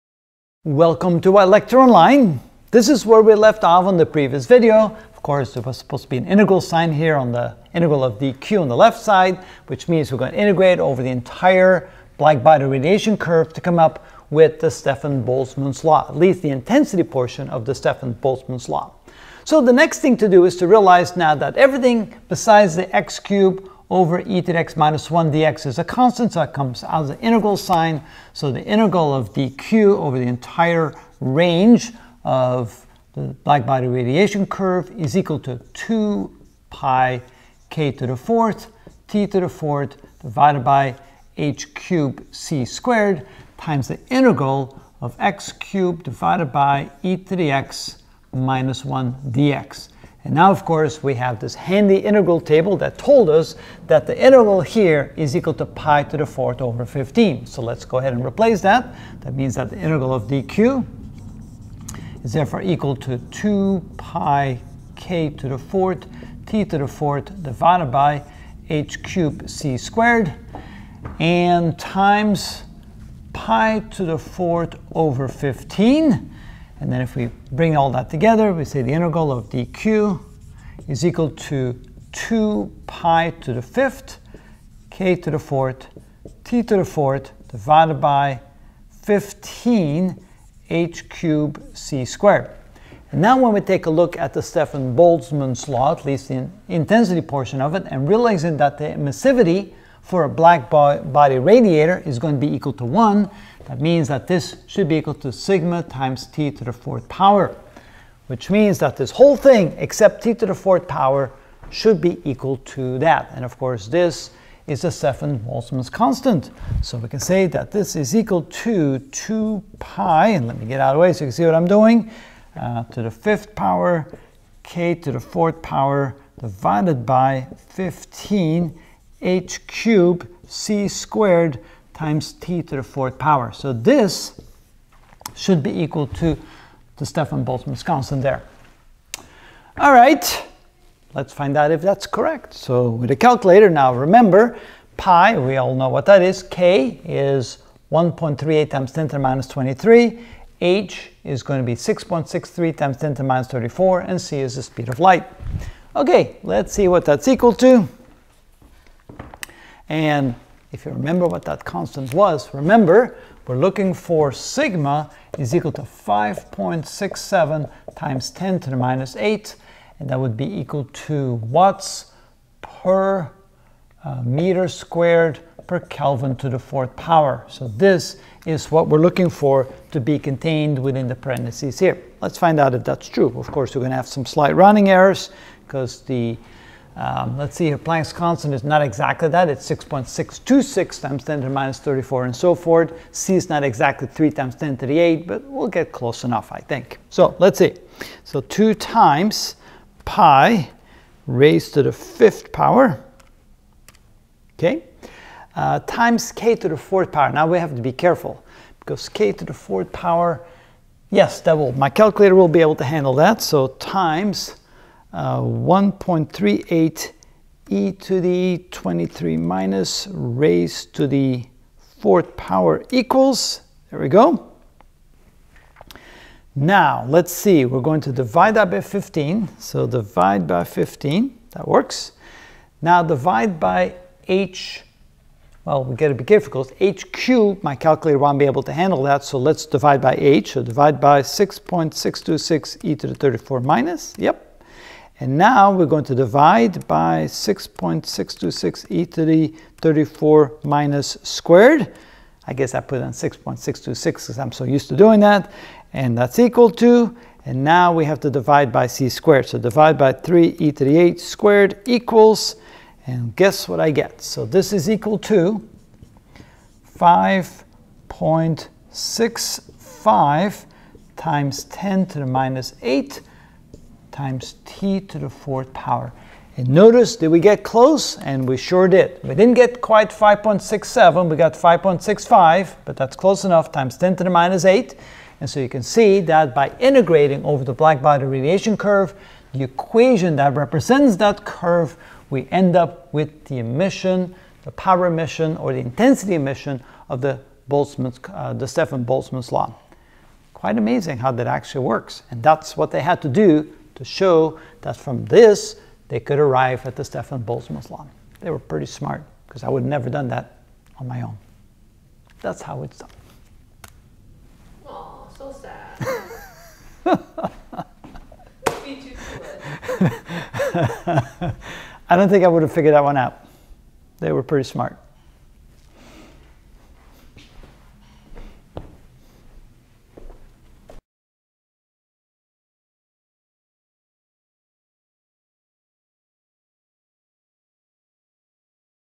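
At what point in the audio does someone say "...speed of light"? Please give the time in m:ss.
2:34.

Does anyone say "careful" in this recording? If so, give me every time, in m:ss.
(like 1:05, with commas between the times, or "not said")
3:27, 3:56.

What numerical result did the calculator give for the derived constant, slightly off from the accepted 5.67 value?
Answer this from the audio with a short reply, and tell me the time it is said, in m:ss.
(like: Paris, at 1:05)
5.65 x 10^-8, at 4:26.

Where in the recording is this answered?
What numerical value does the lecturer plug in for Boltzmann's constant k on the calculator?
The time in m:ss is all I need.
2:27.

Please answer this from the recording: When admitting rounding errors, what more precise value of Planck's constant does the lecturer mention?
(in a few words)
6.626 x 10^-34.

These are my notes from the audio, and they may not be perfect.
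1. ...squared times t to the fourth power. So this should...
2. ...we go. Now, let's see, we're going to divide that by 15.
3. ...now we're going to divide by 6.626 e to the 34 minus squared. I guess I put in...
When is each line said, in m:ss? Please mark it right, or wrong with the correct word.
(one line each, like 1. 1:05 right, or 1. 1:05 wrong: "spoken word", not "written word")
1. 2:10 right
2. 3:43 right
3. 4:05 right.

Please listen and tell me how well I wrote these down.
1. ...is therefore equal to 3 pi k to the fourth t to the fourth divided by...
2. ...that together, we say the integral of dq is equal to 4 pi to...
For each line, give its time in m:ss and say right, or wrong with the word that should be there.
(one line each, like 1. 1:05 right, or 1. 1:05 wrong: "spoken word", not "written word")
1. 1:02 wrong: "2", not "3"
2. 1:17 wrong: "2", not "4".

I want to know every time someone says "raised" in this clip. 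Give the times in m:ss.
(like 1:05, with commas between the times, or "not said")
3:21, 3:40.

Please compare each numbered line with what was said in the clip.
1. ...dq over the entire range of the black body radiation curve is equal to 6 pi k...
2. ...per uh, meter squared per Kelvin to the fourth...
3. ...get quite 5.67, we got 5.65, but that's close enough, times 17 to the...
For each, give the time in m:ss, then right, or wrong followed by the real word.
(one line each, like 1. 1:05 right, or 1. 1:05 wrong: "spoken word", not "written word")
1. 0:29 wrong: "2", not "6"
2. 2:52 right
3. 4:39 wrong: "10", not "17".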